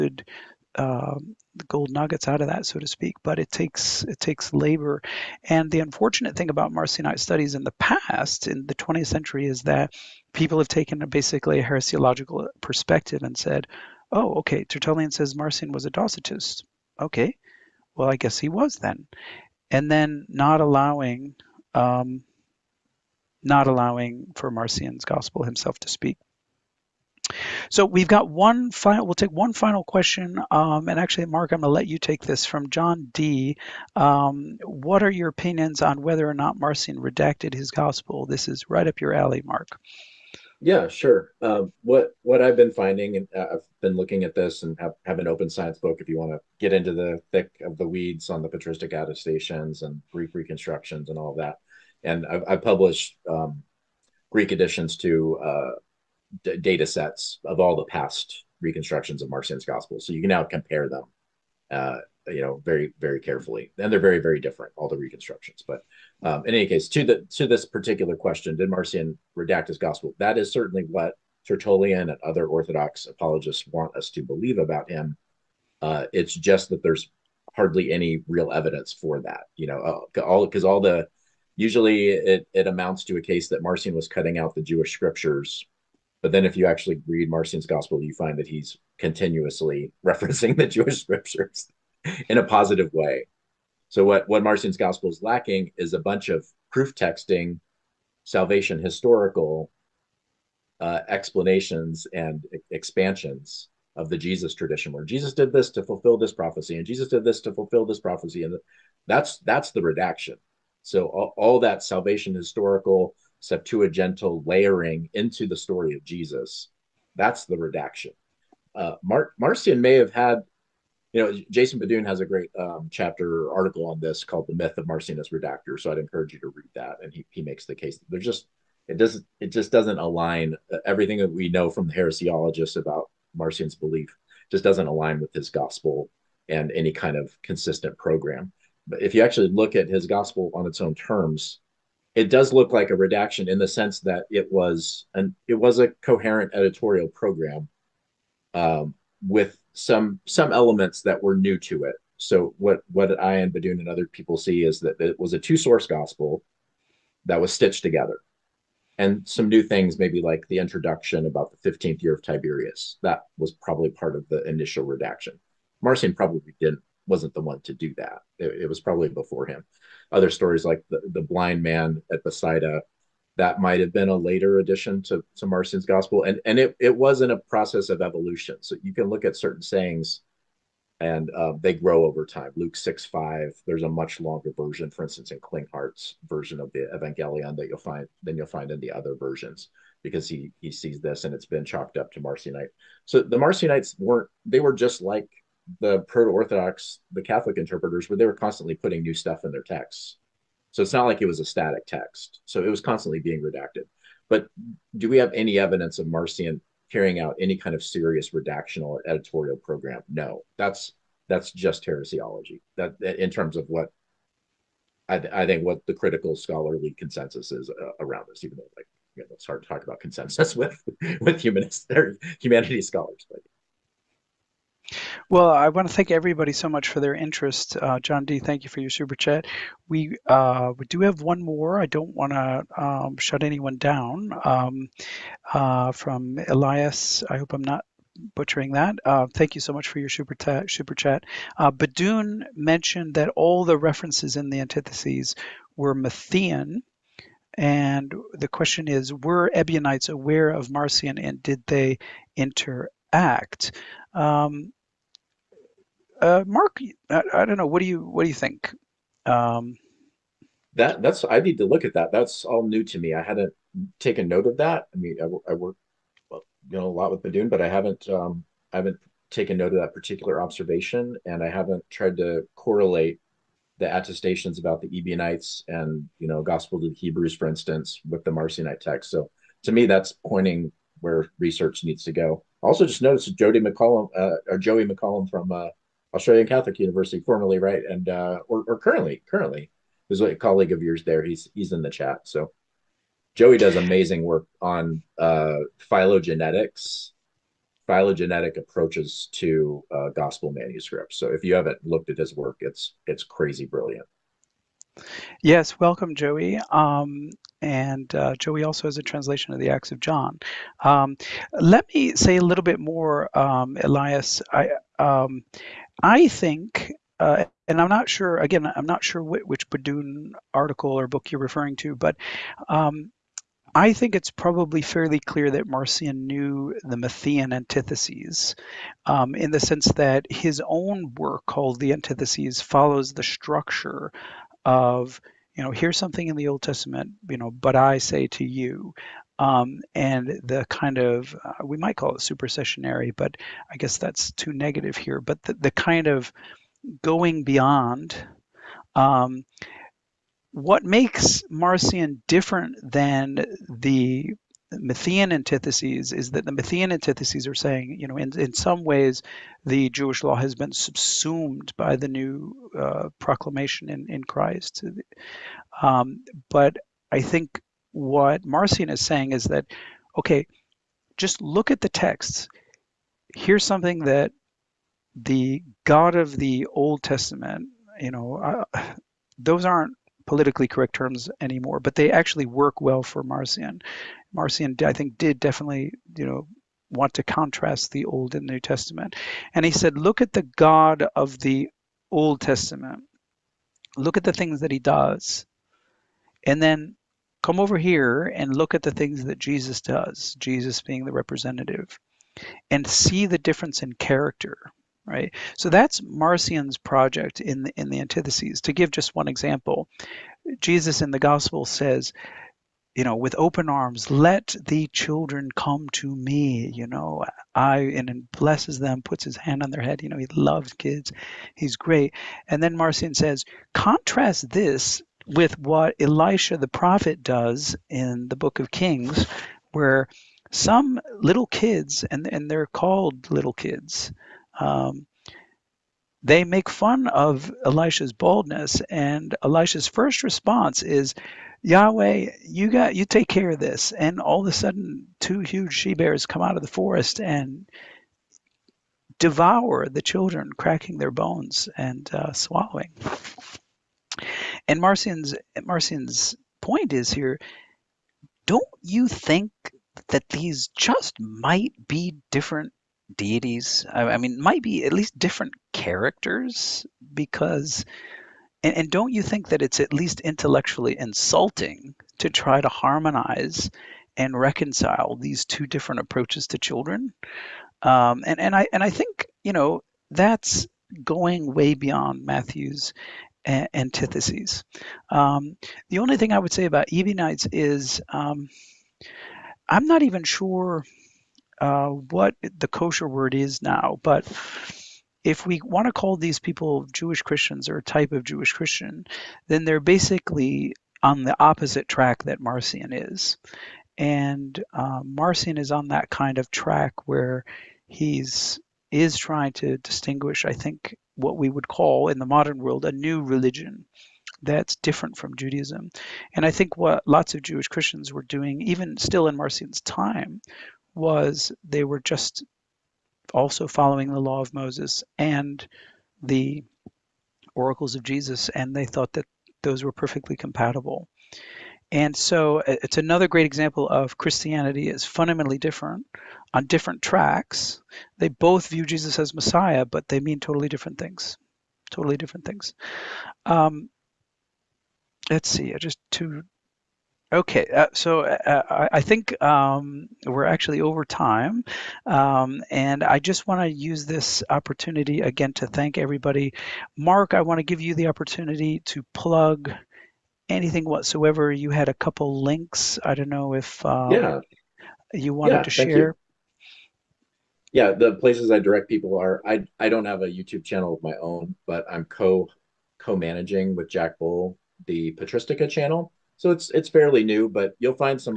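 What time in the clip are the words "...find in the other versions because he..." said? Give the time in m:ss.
3:08.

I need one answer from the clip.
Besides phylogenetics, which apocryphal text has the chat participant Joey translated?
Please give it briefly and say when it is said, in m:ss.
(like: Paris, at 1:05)
Acts of John, at 5:09.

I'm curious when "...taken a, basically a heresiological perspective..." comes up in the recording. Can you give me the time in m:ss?
0:10.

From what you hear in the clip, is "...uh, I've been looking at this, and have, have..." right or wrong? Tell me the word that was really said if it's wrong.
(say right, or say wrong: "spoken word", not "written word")
right.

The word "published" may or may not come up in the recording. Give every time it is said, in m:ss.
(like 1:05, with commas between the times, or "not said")
0:52.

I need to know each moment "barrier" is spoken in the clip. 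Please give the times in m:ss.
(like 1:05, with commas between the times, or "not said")
not said.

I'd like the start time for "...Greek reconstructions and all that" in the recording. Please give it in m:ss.
0:50.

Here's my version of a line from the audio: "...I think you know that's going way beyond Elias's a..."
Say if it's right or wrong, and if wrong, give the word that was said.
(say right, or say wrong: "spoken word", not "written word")
wrong: "Matthew", not "Elias".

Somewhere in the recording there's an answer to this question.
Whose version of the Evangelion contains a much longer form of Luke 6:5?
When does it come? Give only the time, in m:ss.
3:05.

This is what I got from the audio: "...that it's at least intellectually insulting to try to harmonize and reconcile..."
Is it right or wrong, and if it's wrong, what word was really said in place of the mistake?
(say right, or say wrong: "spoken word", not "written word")
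right.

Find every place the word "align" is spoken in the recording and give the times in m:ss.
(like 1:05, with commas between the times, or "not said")
2:09, 2:14.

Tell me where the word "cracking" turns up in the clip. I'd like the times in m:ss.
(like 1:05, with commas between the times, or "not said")
7:30.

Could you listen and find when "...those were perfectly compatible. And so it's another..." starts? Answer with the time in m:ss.
8:49.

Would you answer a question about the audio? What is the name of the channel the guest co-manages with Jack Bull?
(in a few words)
Patristica.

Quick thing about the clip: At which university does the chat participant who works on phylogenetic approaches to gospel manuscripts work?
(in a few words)
Australian Catholic University.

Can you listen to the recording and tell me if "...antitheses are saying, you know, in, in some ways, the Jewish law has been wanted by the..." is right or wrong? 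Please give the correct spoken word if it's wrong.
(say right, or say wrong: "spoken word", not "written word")
wrong: "subsumed", not "wanted".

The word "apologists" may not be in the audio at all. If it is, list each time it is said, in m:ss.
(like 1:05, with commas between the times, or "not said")
1:13.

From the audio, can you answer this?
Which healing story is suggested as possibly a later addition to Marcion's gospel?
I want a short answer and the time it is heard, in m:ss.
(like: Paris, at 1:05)
The blind man at Bethsaida, at 2:51.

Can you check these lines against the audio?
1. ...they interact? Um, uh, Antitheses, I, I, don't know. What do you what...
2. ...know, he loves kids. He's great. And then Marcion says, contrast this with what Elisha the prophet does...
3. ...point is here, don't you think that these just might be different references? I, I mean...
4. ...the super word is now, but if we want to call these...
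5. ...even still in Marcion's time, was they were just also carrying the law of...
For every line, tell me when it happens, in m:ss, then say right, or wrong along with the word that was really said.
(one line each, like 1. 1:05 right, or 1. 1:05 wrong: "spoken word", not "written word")
1. 4:11 wrong: "Mark", not "Antitheses"
2. 7:00 right
3. 7:36 wrong: "deities", not "references"
4. 8:12 wrong: "kosher", not "super"
5. 8:38 wrong: "following", not "carrying".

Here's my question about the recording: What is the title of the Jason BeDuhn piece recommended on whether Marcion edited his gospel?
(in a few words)
The Myth of Marcion as Redactor.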